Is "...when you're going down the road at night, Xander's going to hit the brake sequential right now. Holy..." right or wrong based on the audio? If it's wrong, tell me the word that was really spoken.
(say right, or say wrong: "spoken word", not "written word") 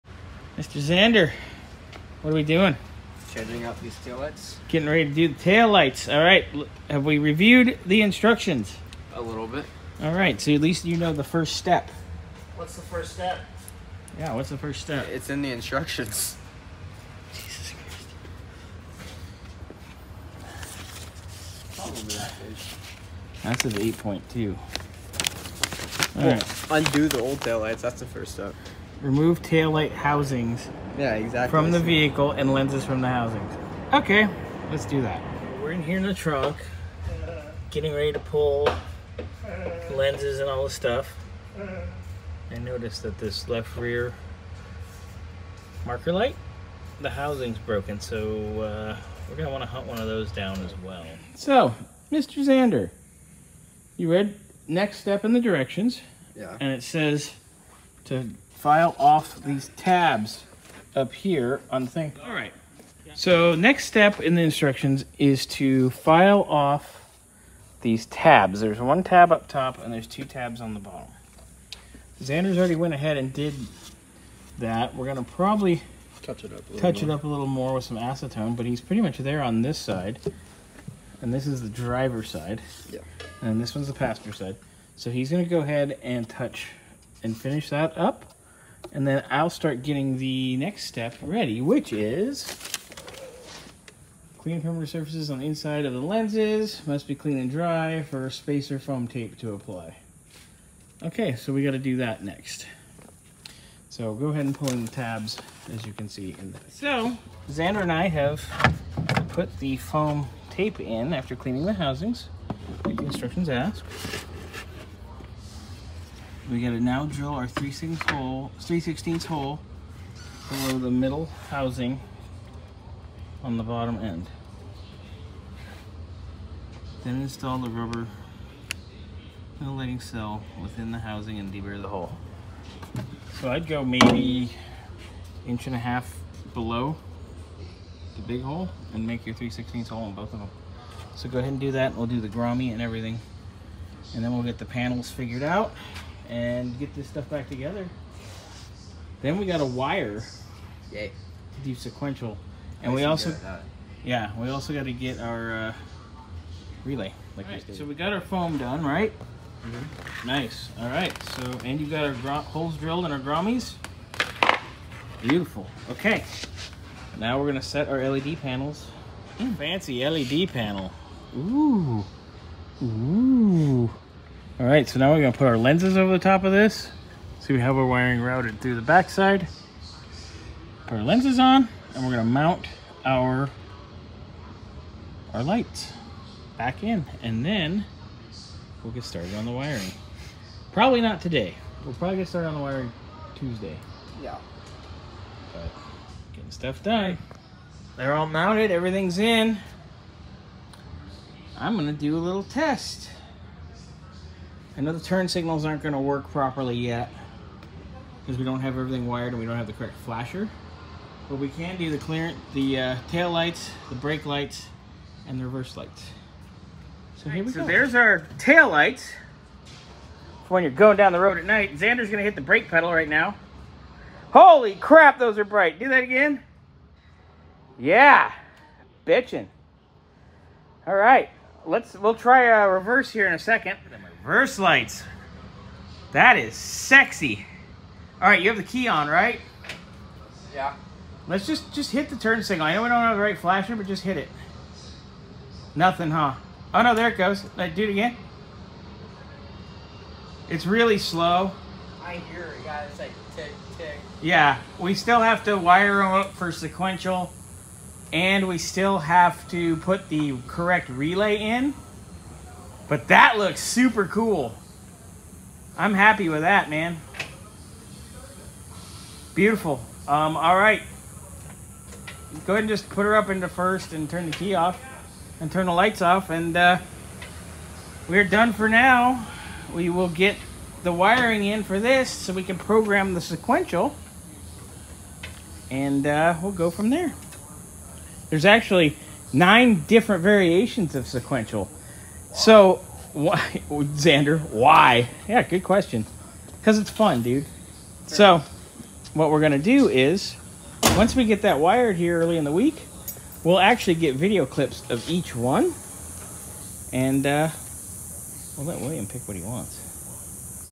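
wrong: "pedal", not "sequential".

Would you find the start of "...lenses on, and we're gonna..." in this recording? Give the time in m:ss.
3:01.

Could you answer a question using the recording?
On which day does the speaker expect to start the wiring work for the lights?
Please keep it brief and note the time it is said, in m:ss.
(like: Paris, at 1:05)
Tuesday, at 3:13.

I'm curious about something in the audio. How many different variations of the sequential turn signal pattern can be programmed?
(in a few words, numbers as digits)
9.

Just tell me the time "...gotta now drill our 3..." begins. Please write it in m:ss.
1:56.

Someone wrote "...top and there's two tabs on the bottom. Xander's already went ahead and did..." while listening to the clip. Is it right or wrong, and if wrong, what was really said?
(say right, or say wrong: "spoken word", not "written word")
right.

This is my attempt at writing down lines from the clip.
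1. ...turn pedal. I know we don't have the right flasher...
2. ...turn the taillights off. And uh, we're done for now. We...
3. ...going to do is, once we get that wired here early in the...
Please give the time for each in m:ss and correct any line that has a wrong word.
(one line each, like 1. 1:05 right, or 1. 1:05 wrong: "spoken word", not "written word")
1. 4:02 wrong: "signal", not "pedal"
2. 4:35 wrong: "lights", not "taillights"
3. 4:59 right.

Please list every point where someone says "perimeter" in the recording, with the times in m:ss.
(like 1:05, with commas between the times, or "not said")
1:34.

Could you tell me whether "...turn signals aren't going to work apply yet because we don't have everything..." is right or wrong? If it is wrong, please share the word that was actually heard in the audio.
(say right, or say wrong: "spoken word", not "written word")
wrong: "properly", not "apply".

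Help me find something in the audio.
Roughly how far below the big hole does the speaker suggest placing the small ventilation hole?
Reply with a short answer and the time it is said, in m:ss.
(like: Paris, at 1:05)
Inch and a half, at 2:15.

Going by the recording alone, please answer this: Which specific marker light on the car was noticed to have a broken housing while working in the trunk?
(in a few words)
Left rear marker light.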